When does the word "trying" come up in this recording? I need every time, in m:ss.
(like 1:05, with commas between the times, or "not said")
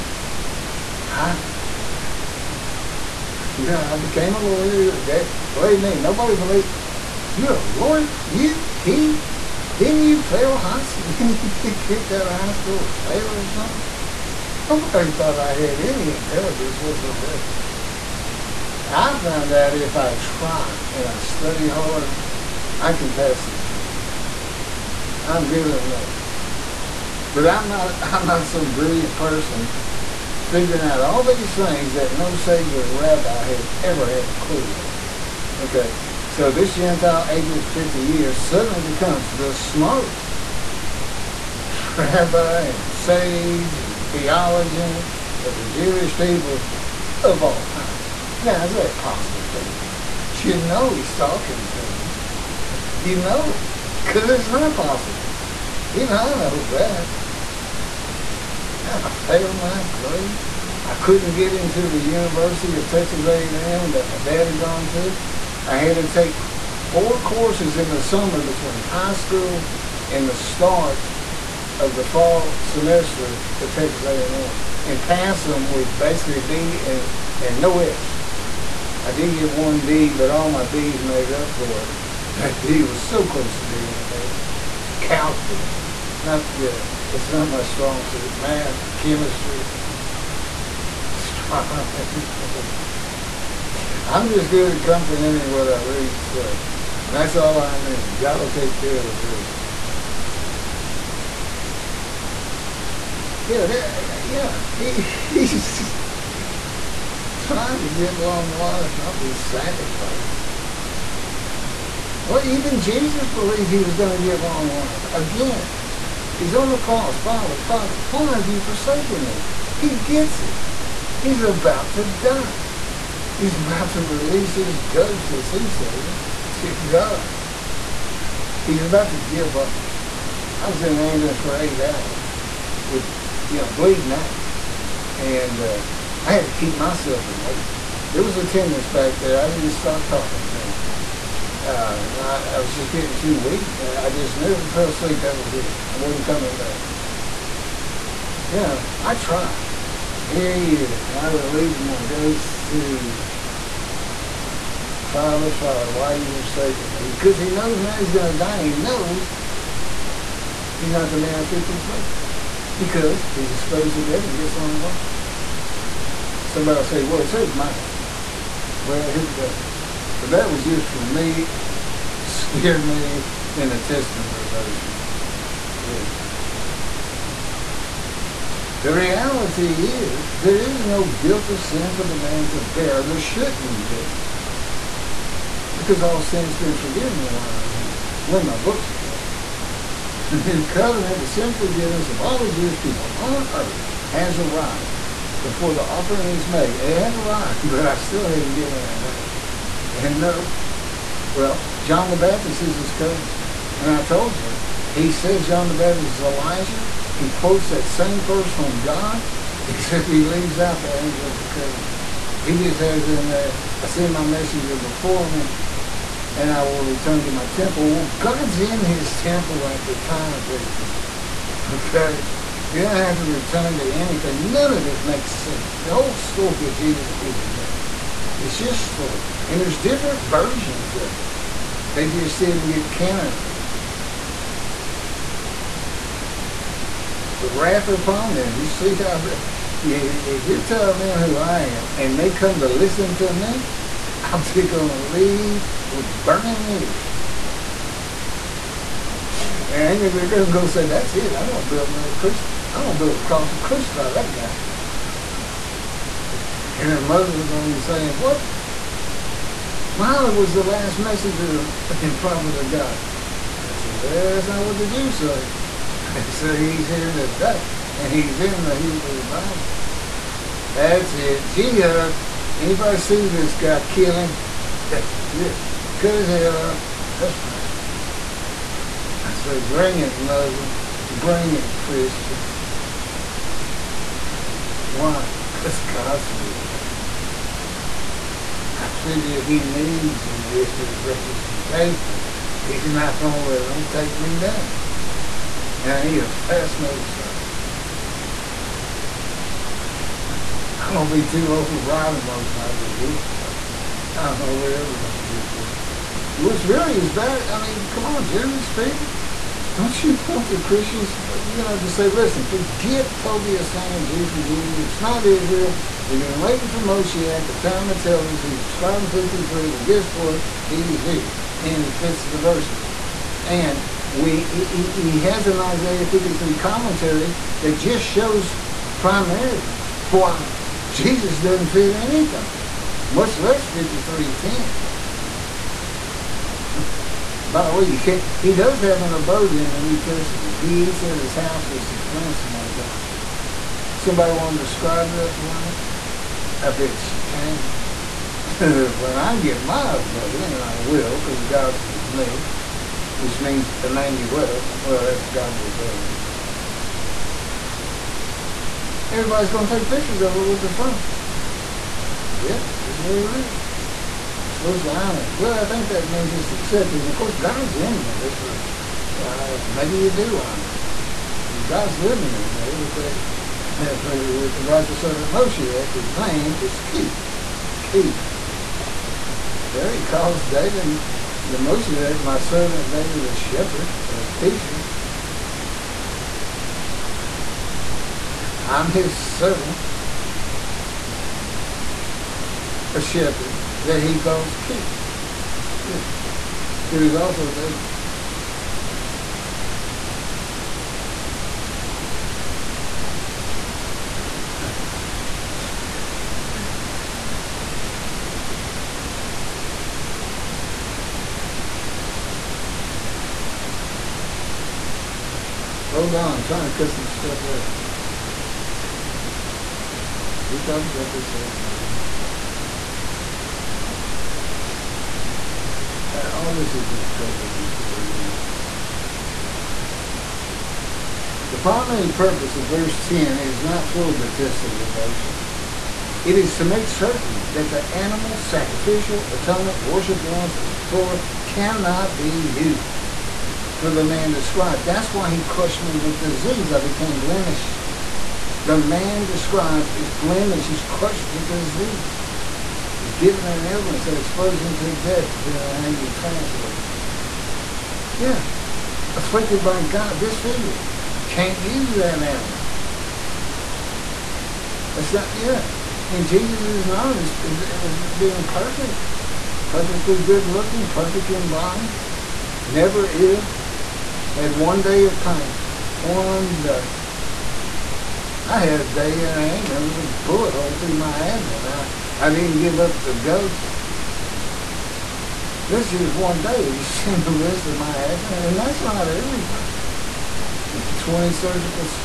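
1:47, 6:56.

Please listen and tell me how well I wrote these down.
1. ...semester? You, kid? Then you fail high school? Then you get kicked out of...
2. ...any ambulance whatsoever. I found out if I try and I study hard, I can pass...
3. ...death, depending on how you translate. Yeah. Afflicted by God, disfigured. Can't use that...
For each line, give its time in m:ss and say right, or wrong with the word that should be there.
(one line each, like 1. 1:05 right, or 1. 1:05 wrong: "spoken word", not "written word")
1. 0:07 wrong: "lawyer", not "semester"
2. 0:15 wrong: "intelligence", not "ambulance"
3. 7:34 right.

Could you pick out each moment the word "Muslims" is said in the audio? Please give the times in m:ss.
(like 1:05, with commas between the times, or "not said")
4:17, 4:40.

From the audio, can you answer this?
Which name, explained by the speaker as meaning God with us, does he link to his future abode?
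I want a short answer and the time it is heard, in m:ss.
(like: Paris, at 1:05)
Emmanuel, at 5:53.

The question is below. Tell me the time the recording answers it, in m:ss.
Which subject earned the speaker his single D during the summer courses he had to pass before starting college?
1:24.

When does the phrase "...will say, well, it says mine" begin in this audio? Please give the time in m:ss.
2:46.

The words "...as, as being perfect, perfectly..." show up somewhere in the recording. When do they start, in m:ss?
7:47.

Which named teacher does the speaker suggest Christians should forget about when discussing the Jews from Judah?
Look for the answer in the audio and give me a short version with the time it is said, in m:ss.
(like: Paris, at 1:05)
Tovia Singer, at 5:13.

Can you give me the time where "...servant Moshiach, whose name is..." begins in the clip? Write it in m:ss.
6:15.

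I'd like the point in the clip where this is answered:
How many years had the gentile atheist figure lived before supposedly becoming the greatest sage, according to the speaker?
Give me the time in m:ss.
0:37.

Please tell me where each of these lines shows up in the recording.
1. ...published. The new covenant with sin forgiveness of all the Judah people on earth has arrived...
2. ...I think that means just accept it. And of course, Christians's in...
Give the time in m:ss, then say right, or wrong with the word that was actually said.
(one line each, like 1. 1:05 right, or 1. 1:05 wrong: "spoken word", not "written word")
1. 3:08 wrong: "Jewish", not "Judah"
2. 6:05 wrong: "God", not "Christians".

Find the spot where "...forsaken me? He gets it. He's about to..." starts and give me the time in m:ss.
1:58.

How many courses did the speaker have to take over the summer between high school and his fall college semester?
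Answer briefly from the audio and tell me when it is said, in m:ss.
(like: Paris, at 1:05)
4, at 1:06.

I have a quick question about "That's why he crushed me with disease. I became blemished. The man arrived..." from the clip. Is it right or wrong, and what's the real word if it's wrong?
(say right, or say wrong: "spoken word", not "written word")
wrong: "described", not "arrived".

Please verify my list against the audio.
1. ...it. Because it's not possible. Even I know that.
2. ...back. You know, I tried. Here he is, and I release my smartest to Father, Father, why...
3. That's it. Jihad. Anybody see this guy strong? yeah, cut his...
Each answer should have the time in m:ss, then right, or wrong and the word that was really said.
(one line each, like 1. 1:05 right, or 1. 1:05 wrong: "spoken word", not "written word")
1. 0:53 right
2. 2:26 wrong: "ghost", not "smartest"
3. 4:30 wrong: "killing", not "strong".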